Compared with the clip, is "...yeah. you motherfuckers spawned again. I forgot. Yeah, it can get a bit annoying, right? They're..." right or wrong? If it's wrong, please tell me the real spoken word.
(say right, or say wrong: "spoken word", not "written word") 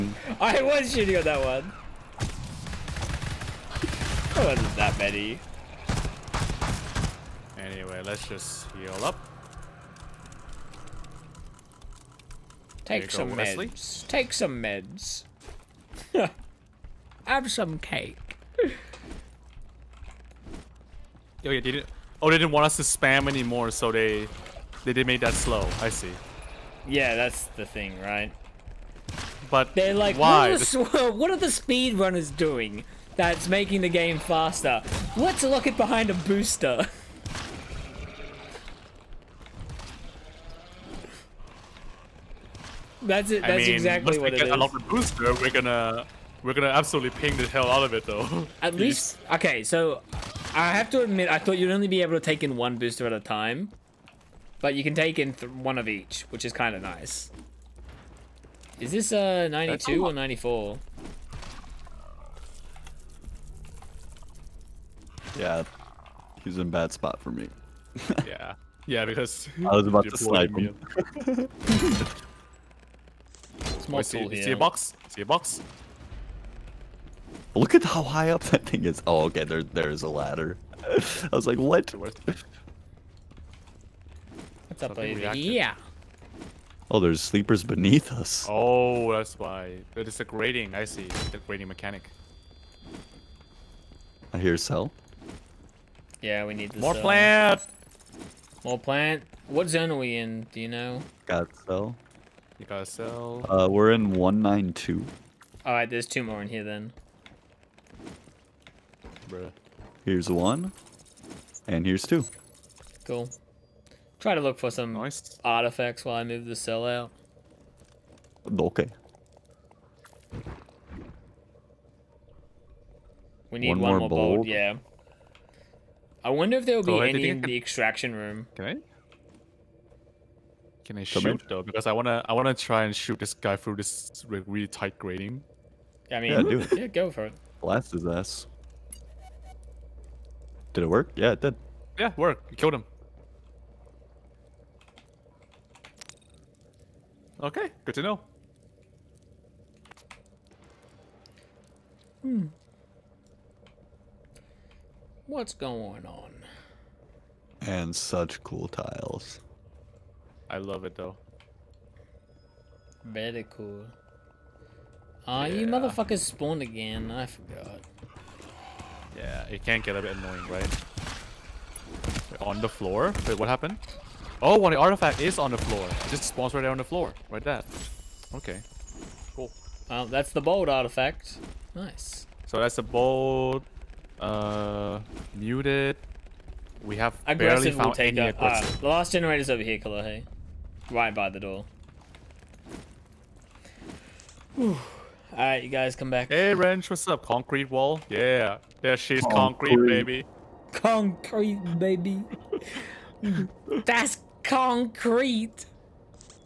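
right.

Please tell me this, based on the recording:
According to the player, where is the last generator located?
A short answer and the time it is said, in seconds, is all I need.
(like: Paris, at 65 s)
Right by the door, at 190 s.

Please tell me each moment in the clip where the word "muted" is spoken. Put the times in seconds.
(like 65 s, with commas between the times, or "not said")
185 s.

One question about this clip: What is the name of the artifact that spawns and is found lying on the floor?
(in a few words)
bold artifact.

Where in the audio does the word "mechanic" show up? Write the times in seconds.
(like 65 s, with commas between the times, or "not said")
91 s.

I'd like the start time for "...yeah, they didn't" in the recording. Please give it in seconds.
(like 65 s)
21 s.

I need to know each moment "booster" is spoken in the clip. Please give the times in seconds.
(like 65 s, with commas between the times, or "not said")
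36 s, 44 s, 52 s.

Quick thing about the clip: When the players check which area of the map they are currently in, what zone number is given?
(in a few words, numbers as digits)
192.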